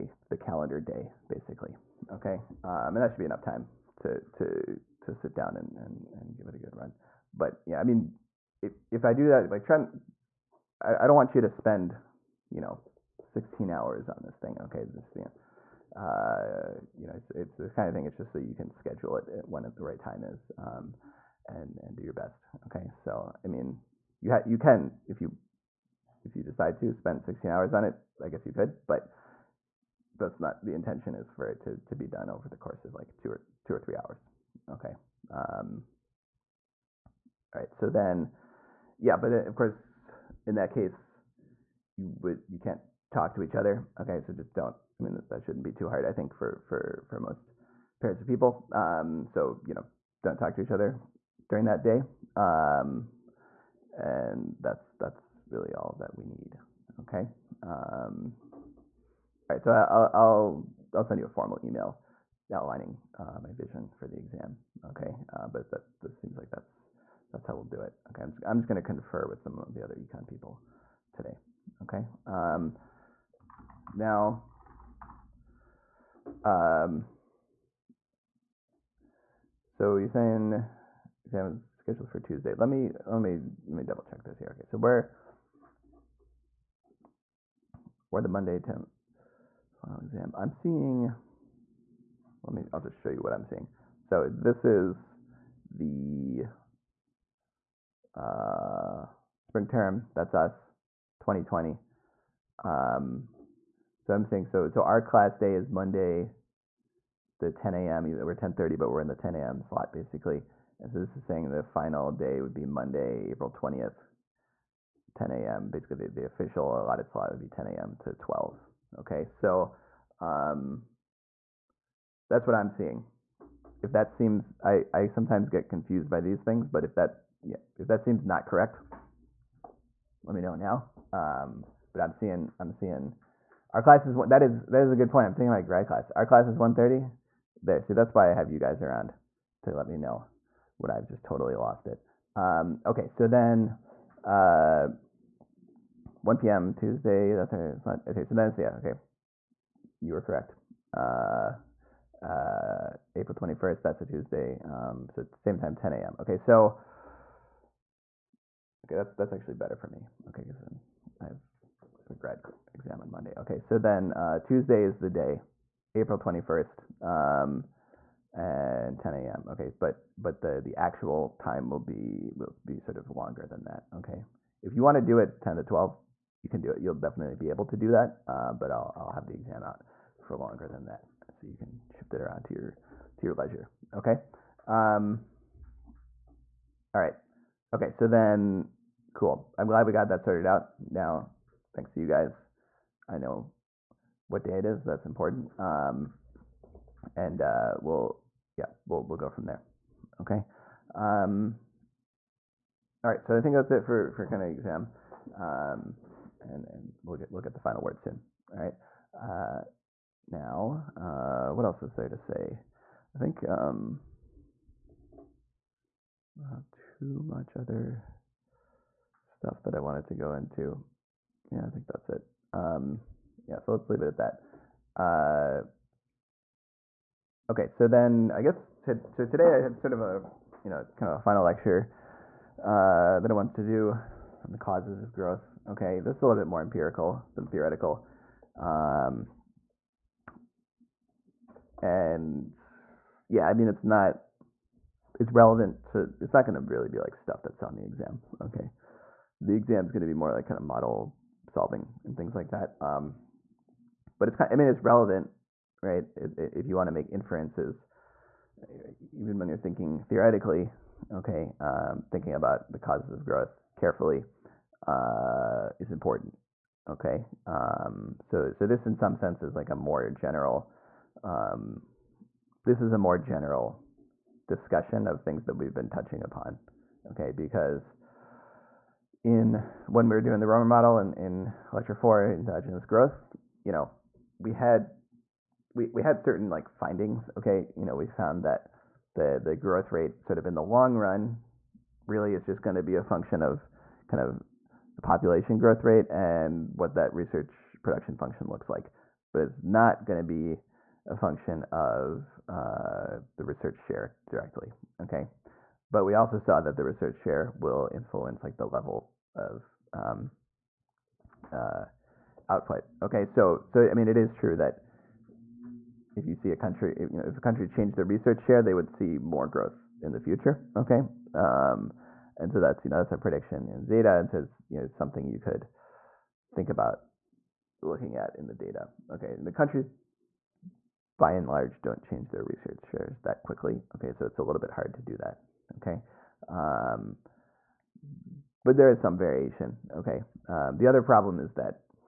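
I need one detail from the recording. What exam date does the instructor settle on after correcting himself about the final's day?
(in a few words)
April 21st.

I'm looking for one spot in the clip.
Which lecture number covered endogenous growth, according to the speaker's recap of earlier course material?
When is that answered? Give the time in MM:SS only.
04:41.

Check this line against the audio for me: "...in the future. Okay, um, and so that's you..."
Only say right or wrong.
right.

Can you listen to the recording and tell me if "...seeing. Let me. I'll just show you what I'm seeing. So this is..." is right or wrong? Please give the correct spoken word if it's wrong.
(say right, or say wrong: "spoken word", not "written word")
right.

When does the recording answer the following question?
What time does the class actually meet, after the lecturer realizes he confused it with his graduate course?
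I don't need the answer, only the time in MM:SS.
02:16.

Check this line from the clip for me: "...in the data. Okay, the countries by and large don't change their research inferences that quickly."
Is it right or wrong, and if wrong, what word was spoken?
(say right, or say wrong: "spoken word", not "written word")
wrong: "shares", not "inferences".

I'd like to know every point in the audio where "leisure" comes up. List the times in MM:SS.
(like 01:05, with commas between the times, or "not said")
03:03.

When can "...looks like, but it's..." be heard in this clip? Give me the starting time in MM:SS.
04:58.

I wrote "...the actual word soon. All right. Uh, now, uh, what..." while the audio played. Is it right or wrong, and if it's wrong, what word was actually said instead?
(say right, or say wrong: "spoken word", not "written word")
wrong: "final", not "actual".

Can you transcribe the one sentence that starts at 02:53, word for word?
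Okay, if you want to do it ten to twelve, you can do it.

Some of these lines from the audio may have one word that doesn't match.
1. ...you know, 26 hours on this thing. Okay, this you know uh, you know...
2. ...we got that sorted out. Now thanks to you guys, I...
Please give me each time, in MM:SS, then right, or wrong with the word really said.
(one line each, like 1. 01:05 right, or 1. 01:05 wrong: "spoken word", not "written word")
1. 00:12 wrong: "16", not "26"
2. 03:09 right.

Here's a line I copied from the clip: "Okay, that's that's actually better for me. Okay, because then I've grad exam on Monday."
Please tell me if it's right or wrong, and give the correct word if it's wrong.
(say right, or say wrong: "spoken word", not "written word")
right.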